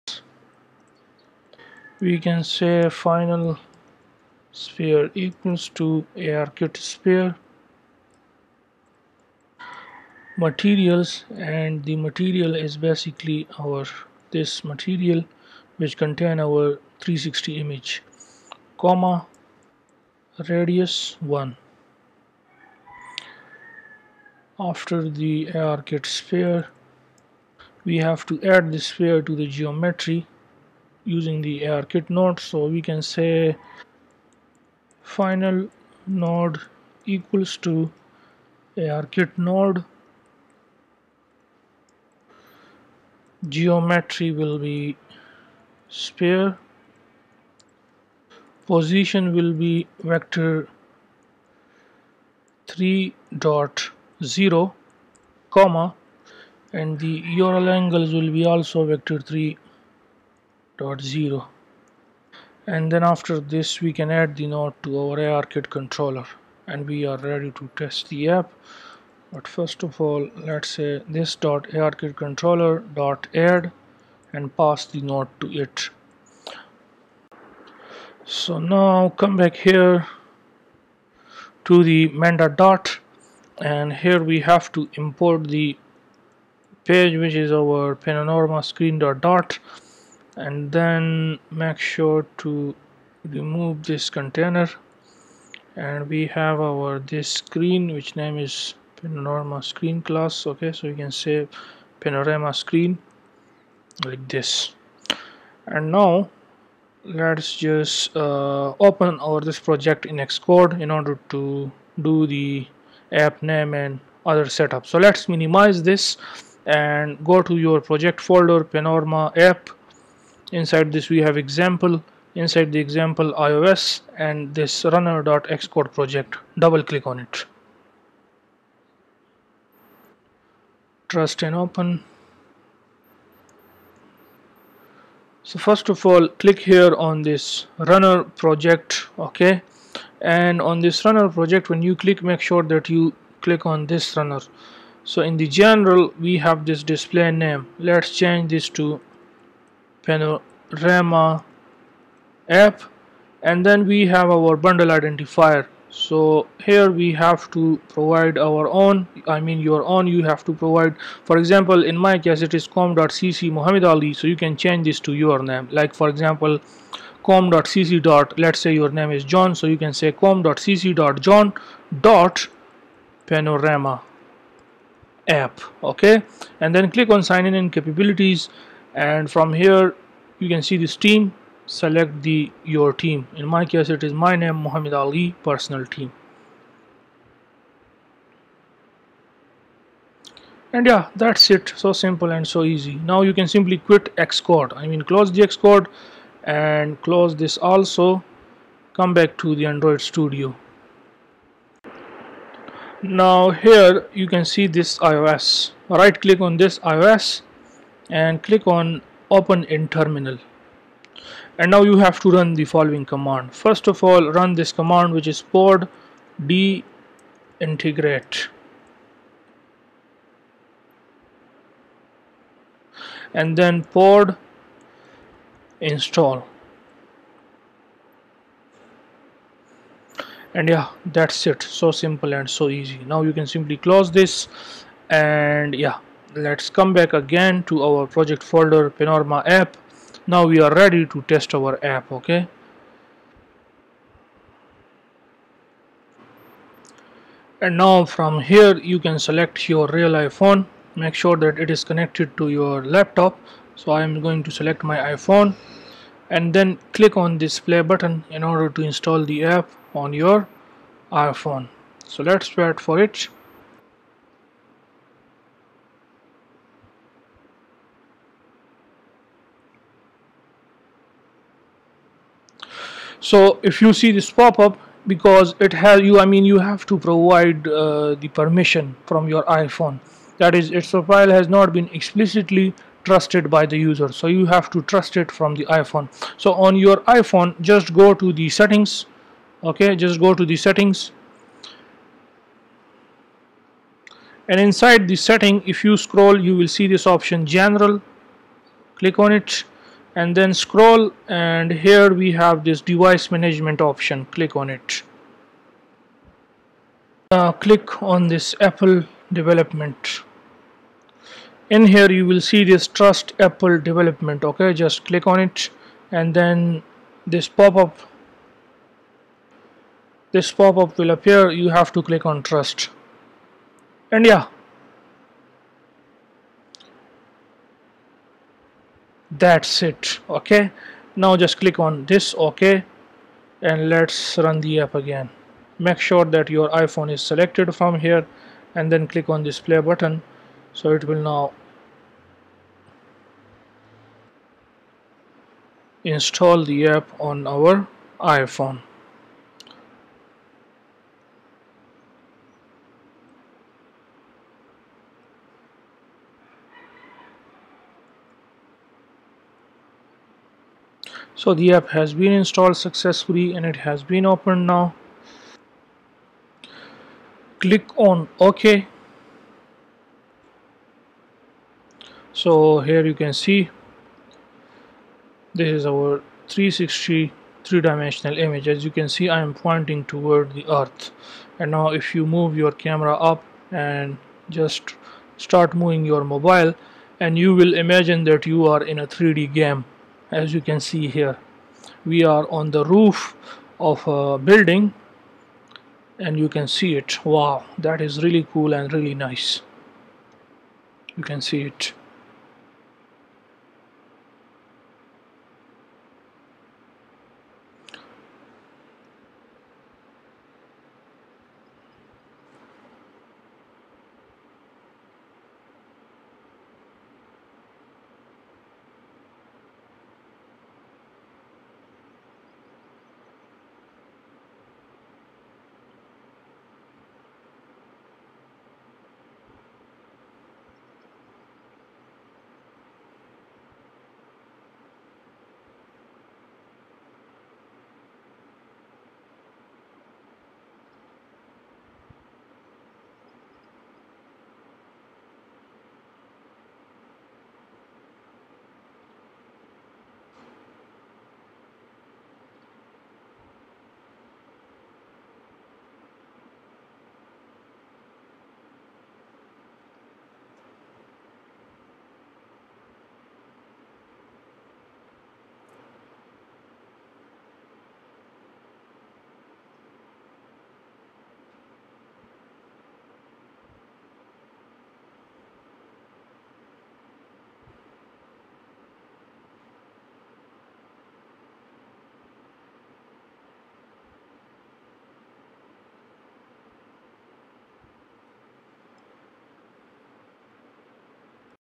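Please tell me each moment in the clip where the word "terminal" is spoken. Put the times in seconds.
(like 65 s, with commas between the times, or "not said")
209 s.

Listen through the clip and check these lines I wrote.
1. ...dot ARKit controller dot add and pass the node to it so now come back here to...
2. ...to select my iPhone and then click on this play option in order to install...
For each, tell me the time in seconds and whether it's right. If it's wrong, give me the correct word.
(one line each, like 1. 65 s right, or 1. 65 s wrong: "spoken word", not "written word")
1. 71 s right
2. 254 s wrong: "button", not "option".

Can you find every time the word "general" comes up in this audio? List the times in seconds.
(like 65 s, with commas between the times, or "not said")
145 s, 297 s.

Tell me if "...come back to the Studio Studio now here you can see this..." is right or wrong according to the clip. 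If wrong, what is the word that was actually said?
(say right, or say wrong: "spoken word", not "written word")
wrong: "Android", not "Studio".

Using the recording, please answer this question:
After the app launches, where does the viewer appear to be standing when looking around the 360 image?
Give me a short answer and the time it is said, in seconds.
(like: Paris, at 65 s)
roof of a building, at 392 s.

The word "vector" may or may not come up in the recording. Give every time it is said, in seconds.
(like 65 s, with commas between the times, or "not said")
50 s, 58 s.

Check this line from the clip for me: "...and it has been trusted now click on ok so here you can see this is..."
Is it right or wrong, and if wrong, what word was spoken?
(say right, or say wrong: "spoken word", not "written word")
wrong: "opened", not "trusted".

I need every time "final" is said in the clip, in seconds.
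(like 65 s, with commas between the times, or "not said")
2 s, 35 s.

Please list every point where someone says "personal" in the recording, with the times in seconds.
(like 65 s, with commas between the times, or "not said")
185 s.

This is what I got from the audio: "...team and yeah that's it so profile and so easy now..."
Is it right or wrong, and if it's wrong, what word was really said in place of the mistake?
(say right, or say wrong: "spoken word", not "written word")
wrong: "simple", not "profile".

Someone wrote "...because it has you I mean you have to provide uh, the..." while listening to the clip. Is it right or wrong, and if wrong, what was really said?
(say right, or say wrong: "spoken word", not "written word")
right.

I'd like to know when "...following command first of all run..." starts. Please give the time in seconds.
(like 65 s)
212 s.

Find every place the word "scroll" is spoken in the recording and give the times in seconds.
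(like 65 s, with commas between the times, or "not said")
296 s, 300 s.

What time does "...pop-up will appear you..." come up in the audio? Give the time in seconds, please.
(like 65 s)
320 s.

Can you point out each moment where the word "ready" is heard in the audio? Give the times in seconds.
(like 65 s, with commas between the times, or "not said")
67 s, 240 s.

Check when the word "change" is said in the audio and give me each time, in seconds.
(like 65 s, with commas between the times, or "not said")
148 s, 164 s.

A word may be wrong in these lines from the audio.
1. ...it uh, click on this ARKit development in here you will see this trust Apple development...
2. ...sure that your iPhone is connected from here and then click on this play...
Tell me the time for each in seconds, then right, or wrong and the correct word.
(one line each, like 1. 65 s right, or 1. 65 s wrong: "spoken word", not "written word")
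1. 304 s wrong: "Apple", not "ARKit"
2. 335 s wrong: "selected", not "connected".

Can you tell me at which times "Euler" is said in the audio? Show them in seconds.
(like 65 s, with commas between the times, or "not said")
57 s.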